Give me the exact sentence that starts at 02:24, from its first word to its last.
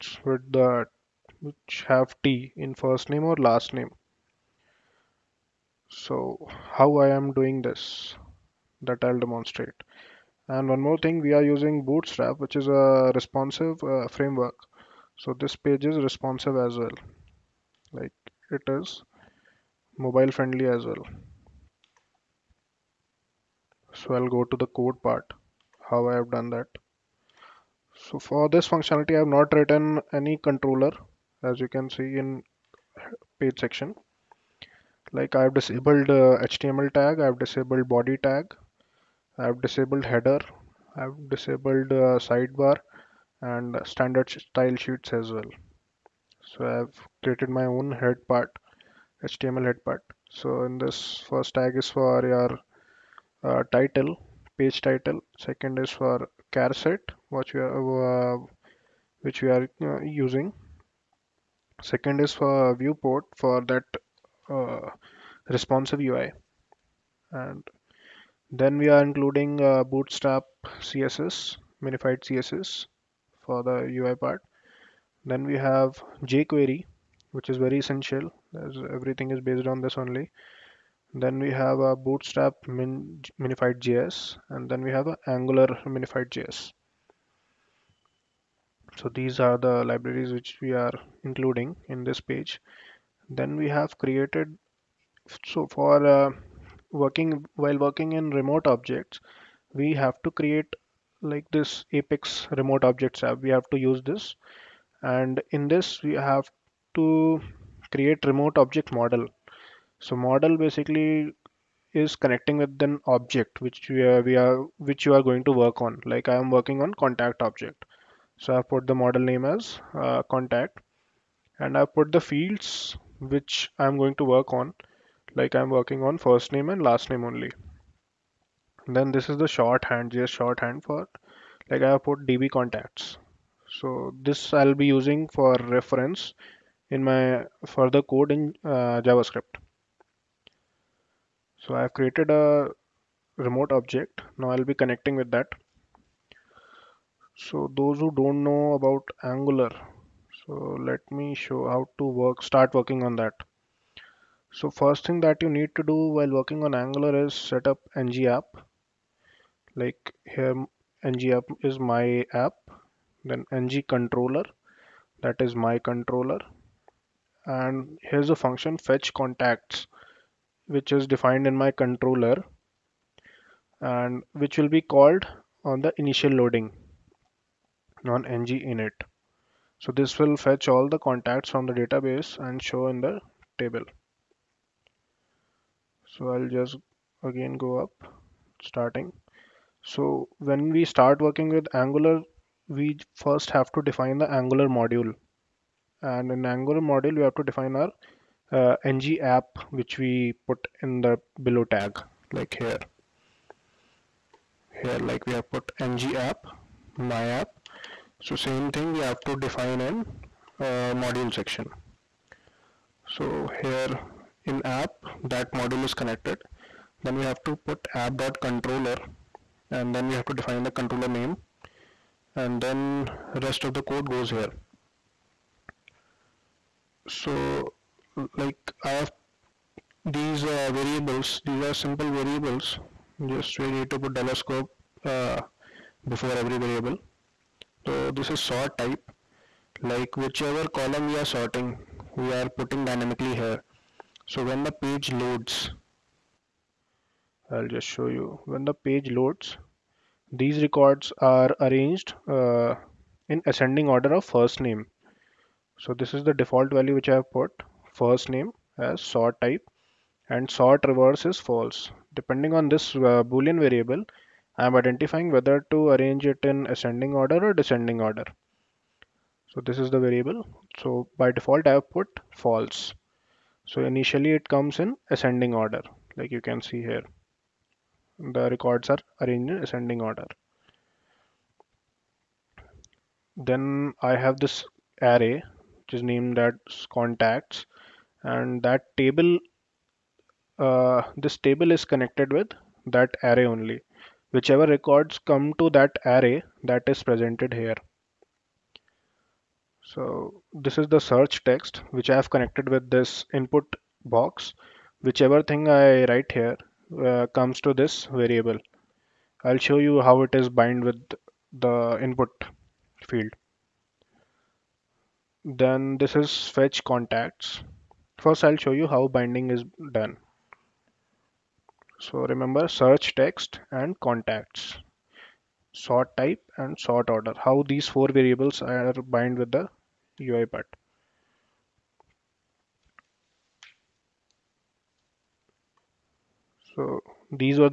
Now I'll be connecting with that.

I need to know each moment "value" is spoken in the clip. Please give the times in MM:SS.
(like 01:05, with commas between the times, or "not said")
04:16.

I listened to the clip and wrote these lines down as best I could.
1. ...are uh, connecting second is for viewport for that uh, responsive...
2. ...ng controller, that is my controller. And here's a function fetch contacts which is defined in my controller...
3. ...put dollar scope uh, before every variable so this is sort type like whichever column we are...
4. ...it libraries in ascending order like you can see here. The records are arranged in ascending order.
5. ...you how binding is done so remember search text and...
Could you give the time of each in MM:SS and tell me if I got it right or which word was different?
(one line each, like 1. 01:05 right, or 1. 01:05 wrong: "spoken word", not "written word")
1. 00:59 wrong: "using", not "connecting"
2. 02:43 right
3. 03:53 right
4. 04:34 wrong: "comes", not "libraries"
5. 05:18 right.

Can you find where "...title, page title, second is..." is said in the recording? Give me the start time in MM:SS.
00:53.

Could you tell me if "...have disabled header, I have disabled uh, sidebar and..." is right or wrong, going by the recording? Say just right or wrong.
right.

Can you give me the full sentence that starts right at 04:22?
Depending on this uh, boolean variable, I am identifying whether to arrange it in ascending order or descending order.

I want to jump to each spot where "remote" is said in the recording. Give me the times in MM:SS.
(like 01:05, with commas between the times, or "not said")
01:38, 01:42, 01:48, 02:23.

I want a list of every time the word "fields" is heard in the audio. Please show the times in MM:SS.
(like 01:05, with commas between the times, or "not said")
02:02, 05:13.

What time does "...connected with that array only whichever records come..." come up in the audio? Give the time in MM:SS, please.
04:51.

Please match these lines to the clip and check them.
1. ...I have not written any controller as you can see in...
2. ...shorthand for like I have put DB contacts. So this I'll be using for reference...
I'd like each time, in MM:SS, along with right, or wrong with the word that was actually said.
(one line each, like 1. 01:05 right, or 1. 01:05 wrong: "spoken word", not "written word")
1. 00:29 right
2. 02:10 right.